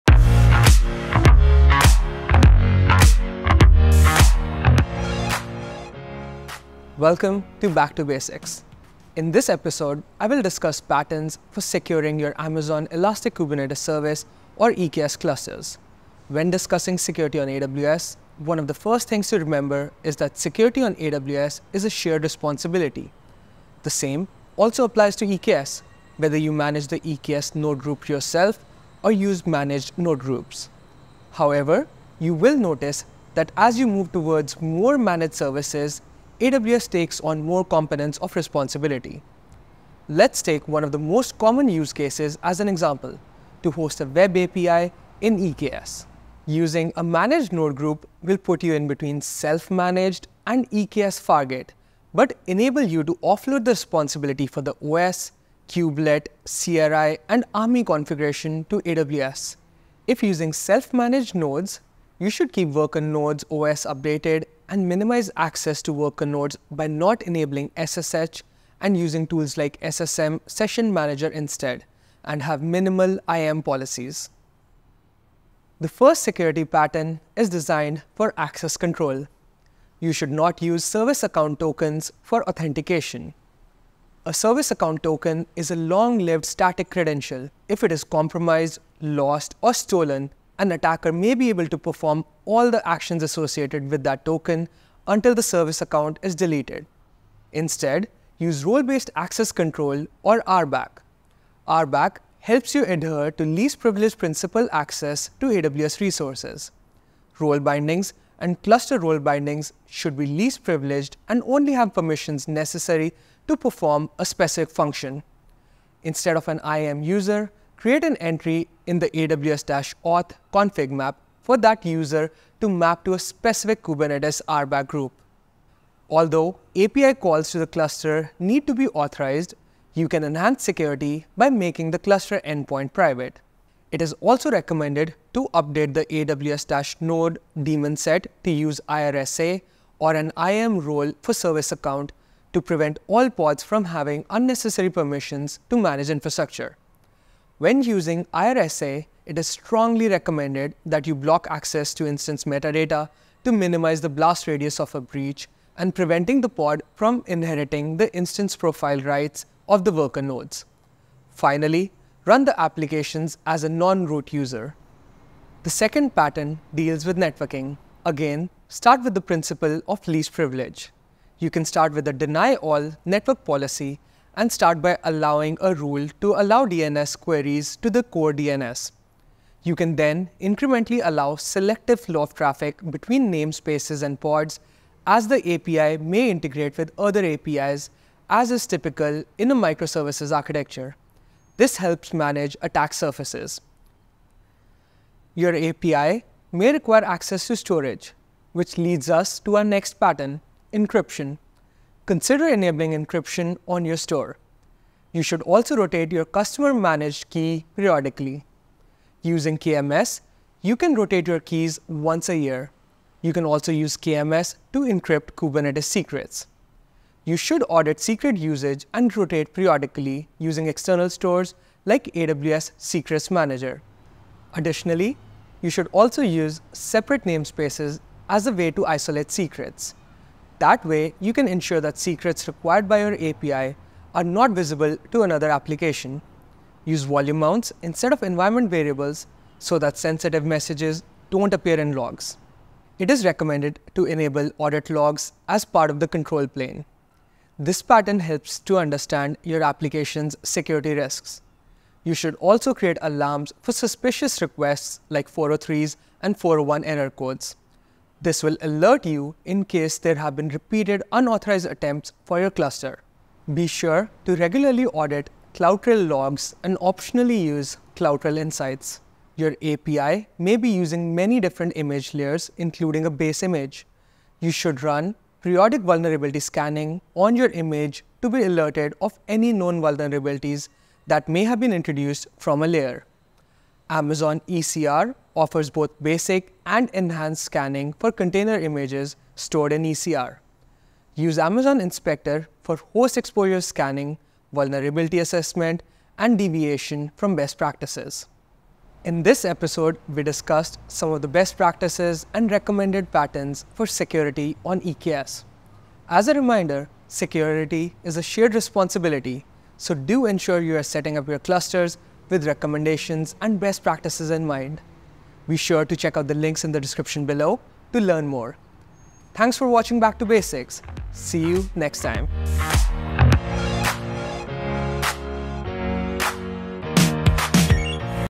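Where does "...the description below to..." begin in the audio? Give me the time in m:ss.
5:16.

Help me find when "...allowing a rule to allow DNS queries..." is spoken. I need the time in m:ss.
2:55.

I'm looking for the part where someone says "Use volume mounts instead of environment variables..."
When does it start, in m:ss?
3:56.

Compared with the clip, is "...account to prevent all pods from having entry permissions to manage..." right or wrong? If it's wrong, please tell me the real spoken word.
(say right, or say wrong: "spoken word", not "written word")
wrong: "unnecessary", not "entry".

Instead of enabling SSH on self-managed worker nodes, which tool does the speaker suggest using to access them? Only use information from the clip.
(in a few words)
SSM Session Manager.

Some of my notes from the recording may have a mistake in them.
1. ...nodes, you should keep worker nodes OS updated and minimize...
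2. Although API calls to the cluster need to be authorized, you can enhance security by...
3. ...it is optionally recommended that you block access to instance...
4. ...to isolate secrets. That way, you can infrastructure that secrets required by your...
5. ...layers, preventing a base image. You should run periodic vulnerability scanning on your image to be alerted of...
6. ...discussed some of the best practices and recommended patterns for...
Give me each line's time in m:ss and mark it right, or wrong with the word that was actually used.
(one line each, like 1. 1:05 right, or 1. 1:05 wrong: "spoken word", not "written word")
1. 1:01 right
2. 2:06 right
3. 2:29 wrong: "strongly", not "optionally"
4. 3:48 wrong: "ensure", not "infrastructure"
5. 4:32 wrong: "including", not "preventing"
6. 5:00 right.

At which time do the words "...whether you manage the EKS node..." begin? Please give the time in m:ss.
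0:26.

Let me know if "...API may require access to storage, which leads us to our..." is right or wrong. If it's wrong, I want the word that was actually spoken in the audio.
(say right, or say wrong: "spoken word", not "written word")
right.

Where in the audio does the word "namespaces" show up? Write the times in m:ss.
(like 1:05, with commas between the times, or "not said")
3:03, 3:47.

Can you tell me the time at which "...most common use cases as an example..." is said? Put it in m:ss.
0:40.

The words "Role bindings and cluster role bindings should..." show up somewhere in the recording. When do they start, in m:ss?
1:47.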